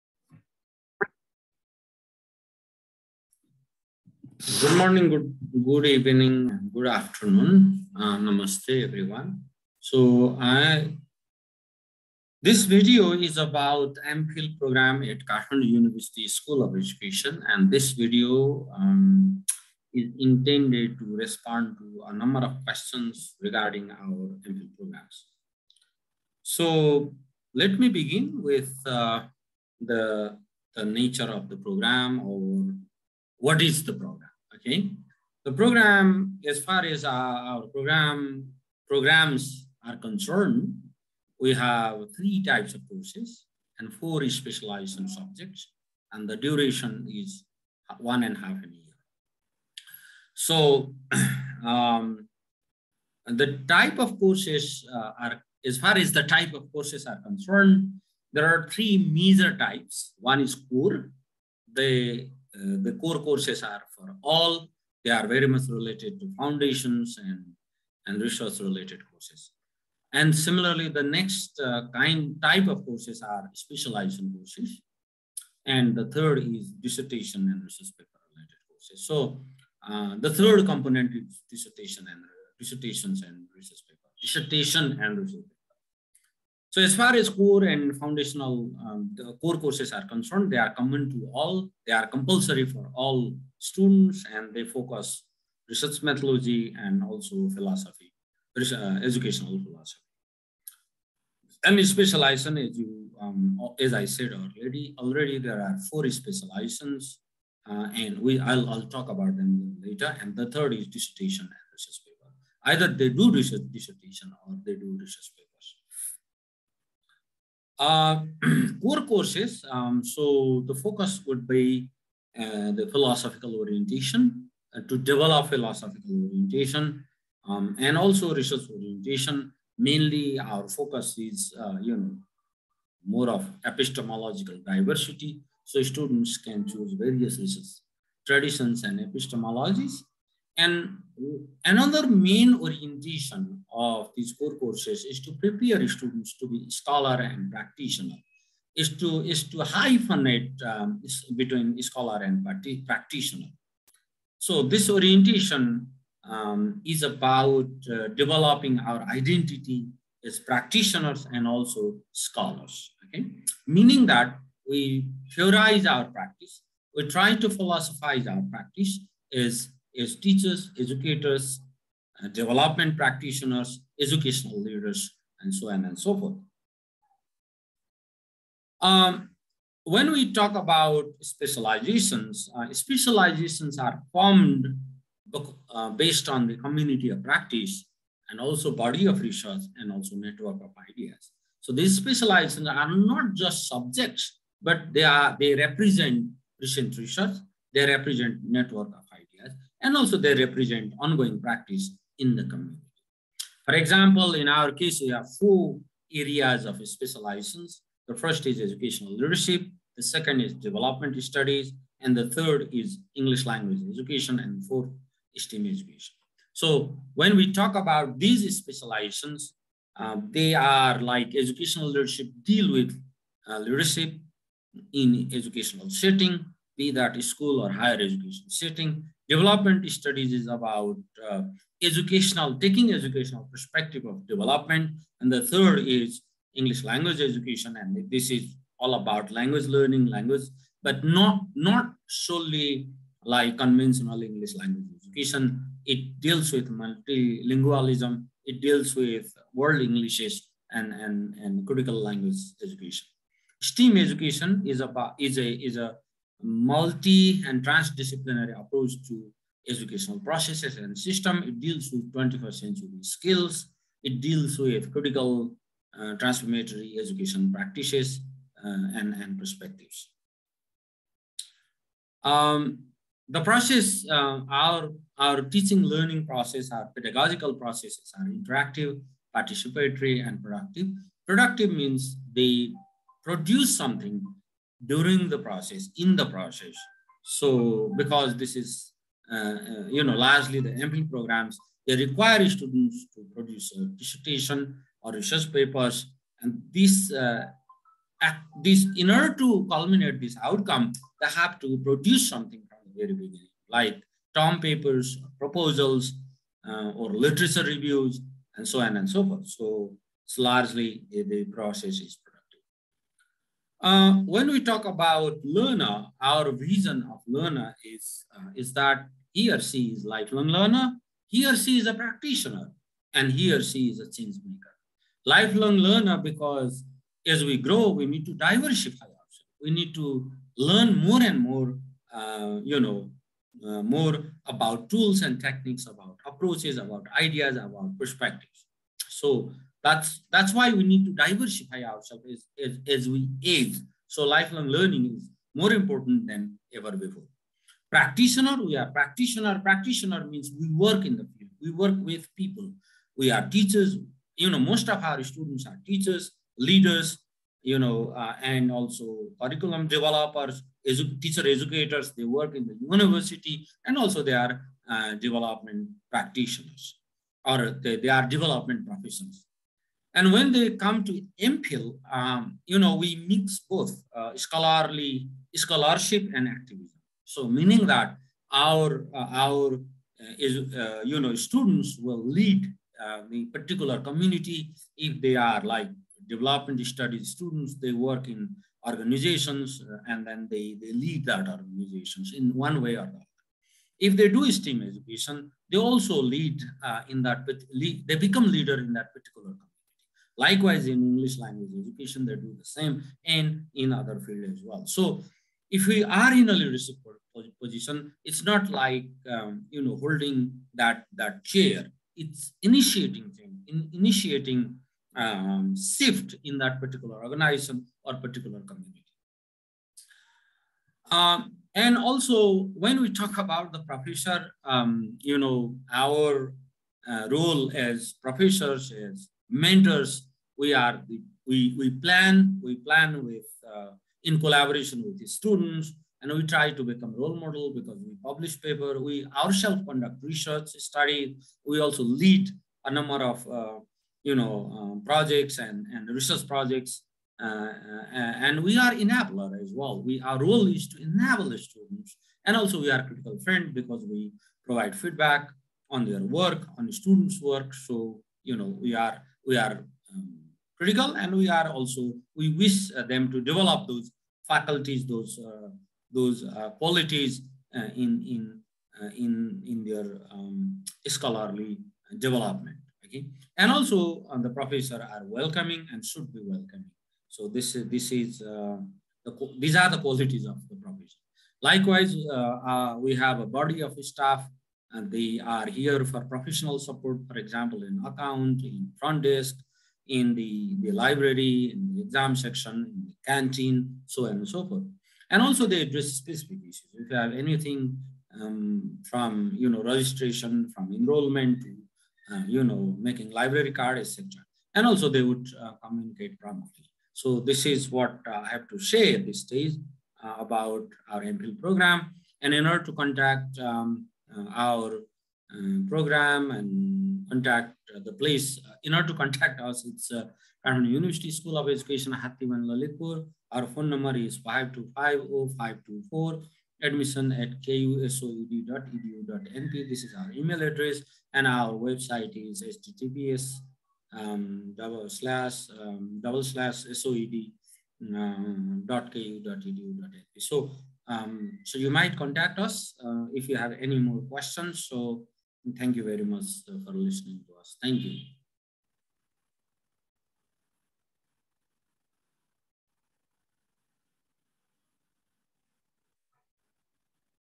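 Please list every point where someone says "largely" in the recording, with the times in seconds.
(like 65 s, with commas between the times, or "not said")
290 s, 310 s.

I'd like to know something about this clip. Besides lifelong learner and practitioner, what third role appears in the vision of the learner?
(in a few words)
Change maker.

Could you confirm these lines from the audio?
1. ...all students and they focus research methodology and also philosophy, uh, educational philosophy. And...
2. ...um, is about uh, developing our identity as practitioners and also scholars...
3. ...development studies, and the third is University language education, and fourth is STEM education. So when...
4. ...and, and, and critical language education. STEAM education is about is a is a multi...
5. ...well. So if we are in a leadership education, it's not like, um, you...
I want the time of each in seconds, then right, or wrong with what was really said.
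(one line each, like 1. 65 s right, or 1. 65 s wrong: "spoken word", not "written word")
1. 92 s right
2. 156 s right
3. 210 s wrong: "English", not "University"
4. 250 s right
5. 404 s wrong: "position", not "education".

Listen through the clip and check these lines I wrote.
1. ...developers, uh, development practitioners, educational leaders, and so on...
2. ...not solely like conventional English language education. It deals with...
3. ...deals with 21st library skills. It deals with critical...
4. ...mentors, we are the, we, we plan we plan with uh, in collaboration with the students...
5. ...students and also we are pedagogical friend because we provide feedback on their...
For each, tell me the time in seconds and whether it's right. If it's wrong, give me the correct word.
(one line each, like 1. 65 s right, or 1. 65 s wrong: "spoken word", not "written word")
1. 170 s wrong: "educators", not "developers"
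2. 241 s right
3. 261 s wrong: "century", not "library"
4. 429 s right
5. 451 s wrong: "critical", not "pedagogical".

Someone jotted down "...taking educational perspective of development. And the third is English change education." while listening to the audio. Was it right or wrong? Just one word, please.
wrong.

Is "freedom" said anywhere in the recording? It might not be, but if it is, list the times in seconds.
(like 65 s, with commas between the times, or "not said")
not said.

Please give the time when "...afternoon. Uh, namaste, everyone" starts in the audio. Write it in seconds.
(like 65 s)
6 s.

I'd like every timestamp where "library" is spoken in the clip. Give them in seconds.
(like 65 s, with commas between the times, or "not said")
490 s, 503 s.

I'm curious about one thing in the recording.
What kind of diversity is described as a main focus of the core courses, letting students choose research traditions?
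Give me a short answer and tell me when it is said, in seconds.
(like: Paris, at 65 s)
Epistemological diversity, at 133 s.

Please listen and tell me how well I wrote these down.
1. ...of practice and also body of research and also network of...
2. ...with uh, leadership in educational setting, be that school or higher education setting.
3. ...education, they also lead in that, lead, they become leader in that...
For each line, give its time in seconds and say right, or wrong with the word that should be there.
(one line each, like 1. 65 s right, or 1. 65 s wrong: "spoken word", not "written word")
1. 187 s right
2. 222 s right
3. 394 s right.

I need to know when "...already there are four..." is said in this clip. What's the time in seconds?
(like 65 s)
104 s.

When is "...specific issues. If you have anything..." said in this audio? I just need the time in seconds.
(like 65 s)
496 s.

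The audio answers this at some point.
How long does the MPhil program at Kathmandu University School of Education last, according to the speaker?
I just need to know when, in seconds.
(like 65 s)
47 s.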